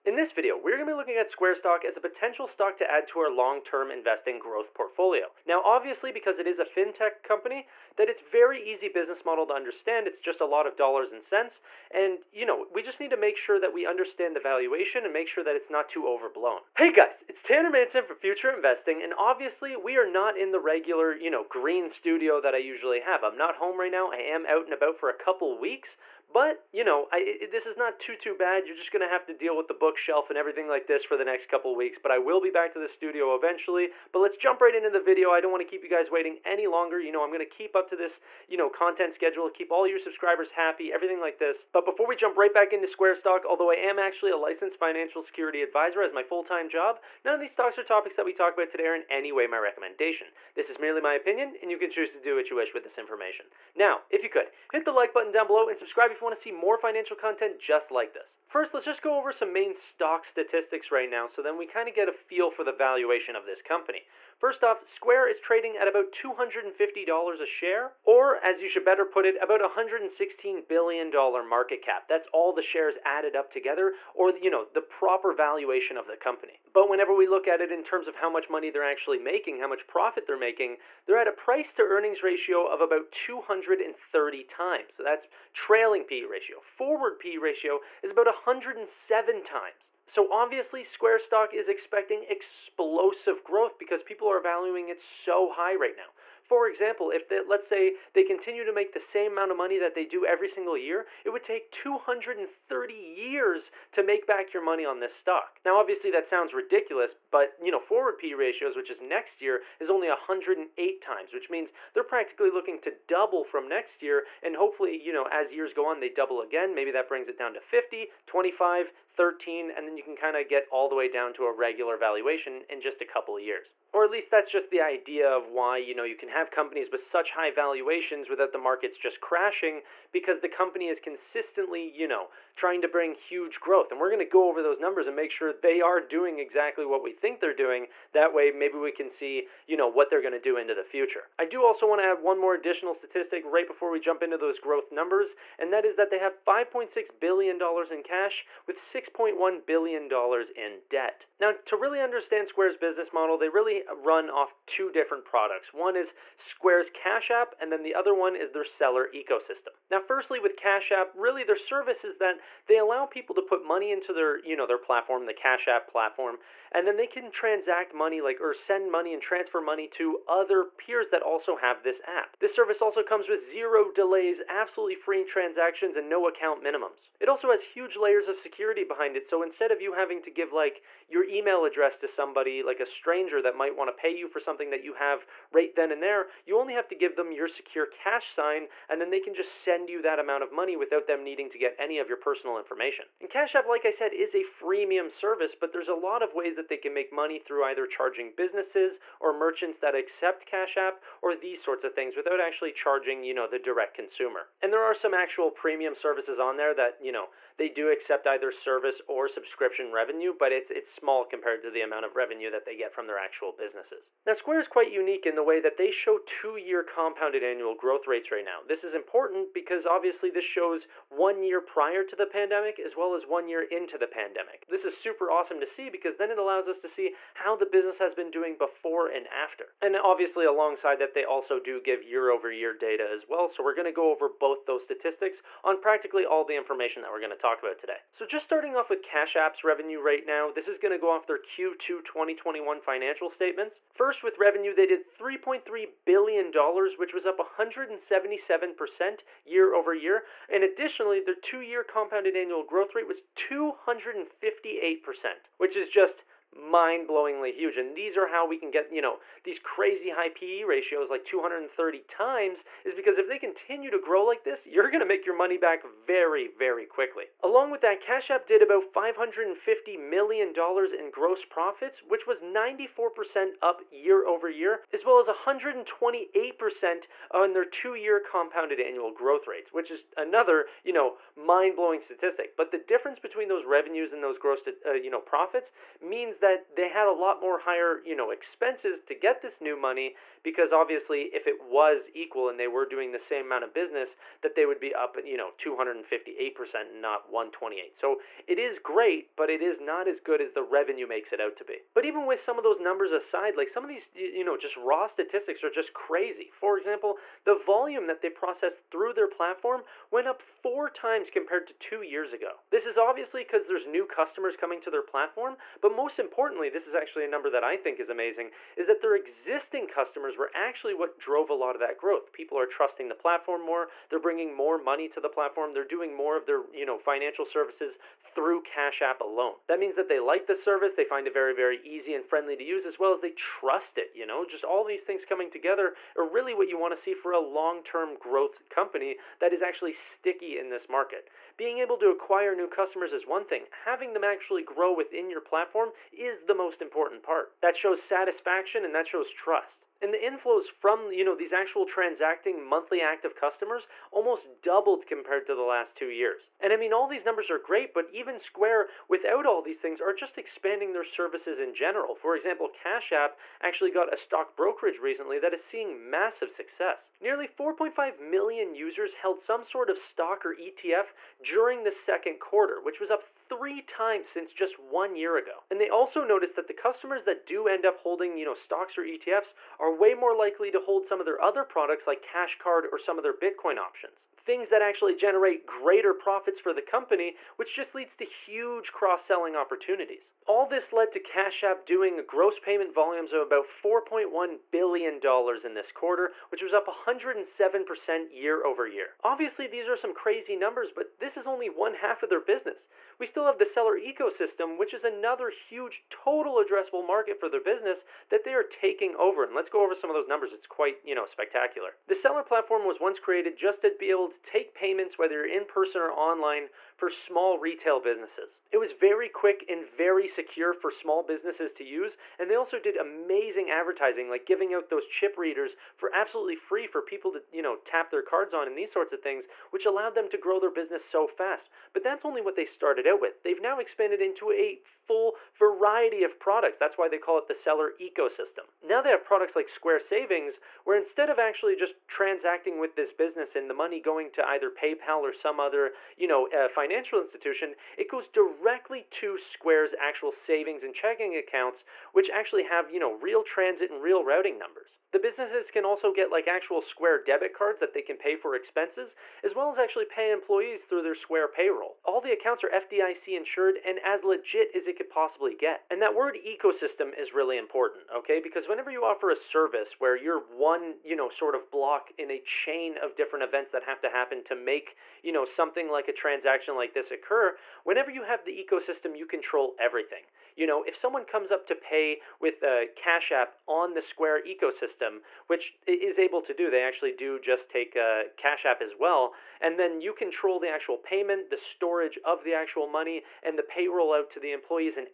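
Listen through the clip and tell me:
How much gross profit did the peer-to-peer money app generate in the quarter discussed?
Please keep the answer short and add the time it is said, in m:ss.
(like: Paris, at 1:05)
$550 million, at 4:28.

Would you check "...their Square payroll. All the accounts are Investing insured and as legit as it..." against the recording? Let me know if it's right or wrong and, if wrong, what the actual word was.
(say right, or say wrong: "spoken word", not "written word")
wrong: "FDIC", not "Investing".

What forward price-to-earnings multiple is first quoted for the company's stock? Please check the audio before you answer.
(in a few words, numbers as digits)
107.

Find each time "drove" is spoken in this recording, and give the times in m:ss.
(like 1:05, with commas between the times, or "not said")
5:21.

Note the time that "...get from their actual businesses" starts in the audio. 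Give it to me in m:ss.
3:32.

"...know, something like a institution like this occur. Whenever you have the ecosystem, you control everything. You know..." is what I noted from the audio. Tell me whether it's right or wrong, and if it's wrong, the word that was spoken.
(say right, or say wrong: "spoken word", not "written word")
wrong: "transaction", not "institution".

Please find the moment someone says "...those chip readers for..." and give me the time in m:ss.
7:04.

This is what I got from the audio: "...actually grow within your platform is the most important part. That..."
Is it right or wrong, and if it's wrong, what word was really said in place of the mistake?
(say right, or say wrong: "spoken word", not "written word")
right.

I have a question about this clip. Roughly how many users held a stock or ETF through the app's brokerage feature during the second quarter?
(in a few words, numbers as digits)
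4.5 million.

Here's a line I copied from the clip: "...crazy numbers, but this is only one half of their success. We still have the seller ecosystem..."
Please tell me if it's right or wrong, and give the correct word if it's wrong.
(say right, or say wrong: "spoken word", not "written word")
wrong: "business", not "success".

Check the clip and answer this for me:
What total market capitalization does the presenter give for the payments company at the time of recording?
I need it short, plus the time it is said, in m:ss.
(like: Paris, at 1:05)
$116 billion, at 1:09.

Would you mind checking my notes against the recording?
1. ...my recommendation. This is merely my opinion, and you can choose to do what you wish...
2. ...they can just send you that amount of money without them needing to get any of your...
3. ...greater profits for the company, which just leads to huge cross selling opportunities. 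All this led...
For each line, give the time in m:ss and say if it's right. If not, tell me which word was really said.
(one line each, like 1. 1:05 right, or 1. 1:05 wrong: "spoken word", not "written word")
1. 0:49 right
2. 3:09 right
3. 6:25 right.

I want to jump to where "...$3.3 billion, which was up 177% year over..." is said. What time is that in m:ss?
4:05.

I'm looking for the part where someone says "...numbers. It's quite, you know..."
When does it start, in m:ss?
6:50.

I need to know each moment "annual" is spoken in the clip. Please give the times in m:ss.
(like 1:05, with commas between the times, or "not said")
3:37, 4:12, 4:38.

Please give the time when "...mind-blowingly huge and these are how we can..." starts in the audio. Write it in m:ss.
4:16.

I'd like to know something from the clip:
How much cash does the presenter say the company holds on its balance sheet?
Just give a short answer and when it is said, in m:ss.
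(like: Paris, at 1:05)
$5.6 billion, at 2:26.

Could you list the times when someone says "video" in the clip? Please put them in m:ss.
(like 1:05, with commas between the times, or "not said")
0:00, 0:34.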